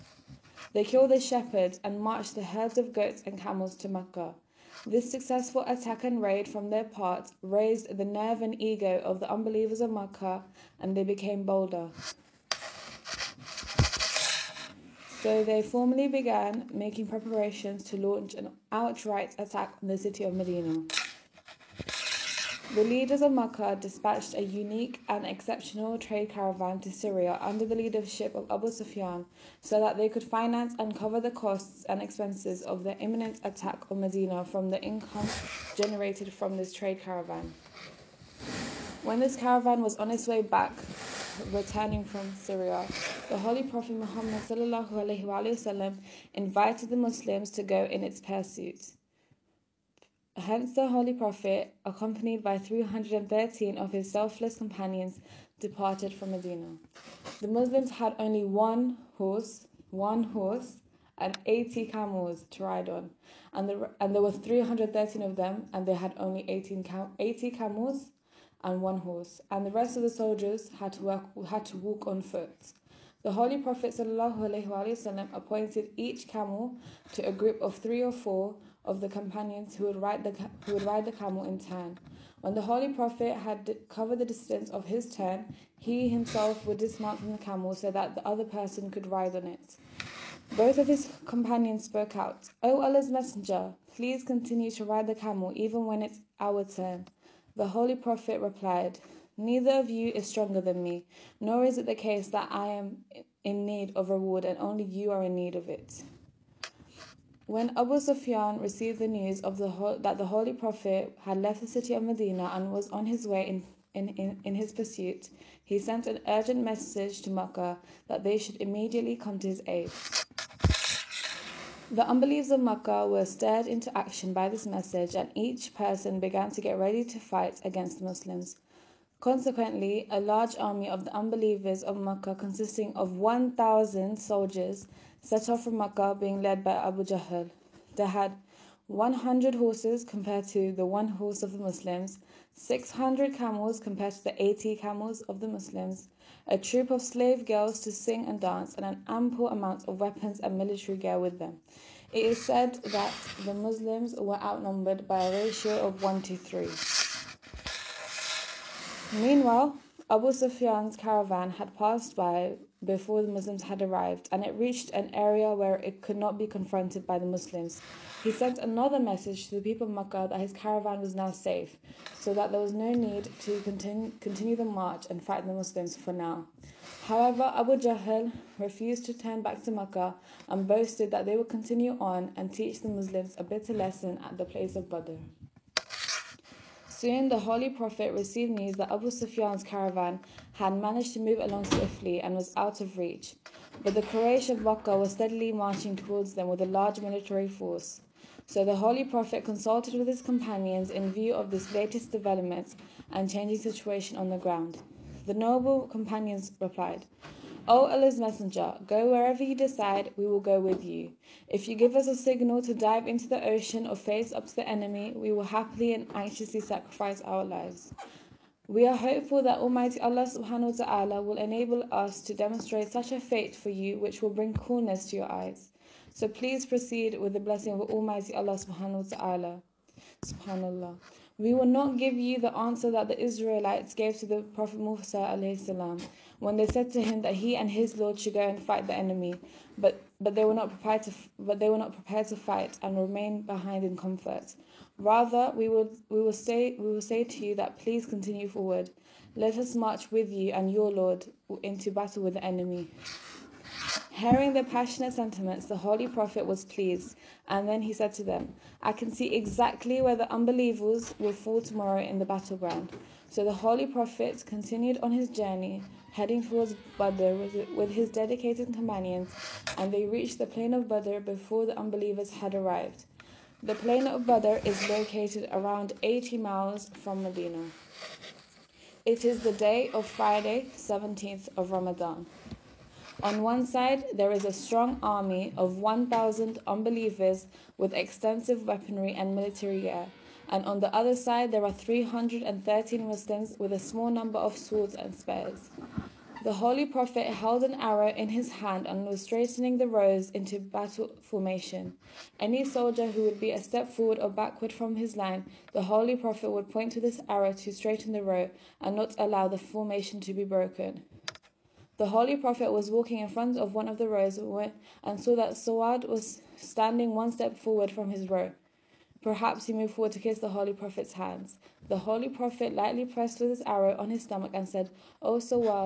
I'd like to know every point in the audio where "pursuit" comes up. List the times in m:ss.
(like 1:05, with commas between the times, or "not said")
0:48, 1:54.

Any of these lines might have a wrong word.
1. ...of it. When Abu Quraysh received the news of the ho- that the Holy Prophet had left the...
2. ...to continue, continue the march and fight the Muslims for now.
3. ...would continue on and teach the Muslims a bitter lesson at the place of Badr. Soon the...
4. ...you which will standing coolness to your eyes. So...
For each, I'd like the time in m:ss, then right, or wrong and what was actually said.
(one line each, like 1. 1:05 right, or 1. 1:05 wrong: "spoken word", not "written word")
1. 1:45 wrong: "Sufyan", not "Quraysh"
2. 2:53 right
3. 3:01 right
4. 3:43 wrong: "bring", not "standing".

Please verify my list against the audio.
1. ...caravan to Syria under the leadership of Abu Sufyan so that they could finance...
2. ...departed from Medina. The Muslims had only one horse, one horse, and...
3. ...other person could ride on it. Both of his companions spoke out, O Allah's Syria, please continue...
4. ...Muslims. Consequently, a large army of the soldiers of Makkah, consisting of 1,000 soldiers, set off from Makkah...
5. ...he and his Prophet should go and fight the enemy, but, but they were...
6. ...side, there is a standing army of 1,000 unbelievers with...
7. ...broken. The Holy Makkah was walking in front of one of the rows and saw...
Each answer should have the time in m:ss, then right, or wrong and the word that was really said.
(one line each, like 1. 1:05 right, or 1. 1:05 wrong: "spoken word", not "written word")
1. 0:26 right
2. 0:55 right
3. 1:28 wrong: "Messenger", not "Syria"
4. 2:08 wrong: "unbelievers", not "soldiers"
5. 3:57 wrong: "Lord", not "Prophet"
6. 4:43 wrong: "strong", not "standing"
7. 5:10 wrong: "Prophet", not "Makkah".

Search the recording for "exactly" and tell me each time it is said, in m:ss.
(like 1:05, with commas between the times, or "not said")
4:19.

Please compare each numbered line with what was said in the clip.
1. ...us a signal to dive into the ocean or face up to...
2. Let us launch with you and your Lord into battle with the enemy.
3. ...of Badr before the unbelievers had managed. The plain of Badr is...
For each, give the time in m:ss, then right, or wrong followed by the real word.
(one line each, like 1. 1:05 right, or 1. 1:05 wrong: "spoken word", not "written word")
1. 3:31 right
2. 4:09 wrong: "march", not "launch"
3. 4:30 wrong: "arrived", not "managed".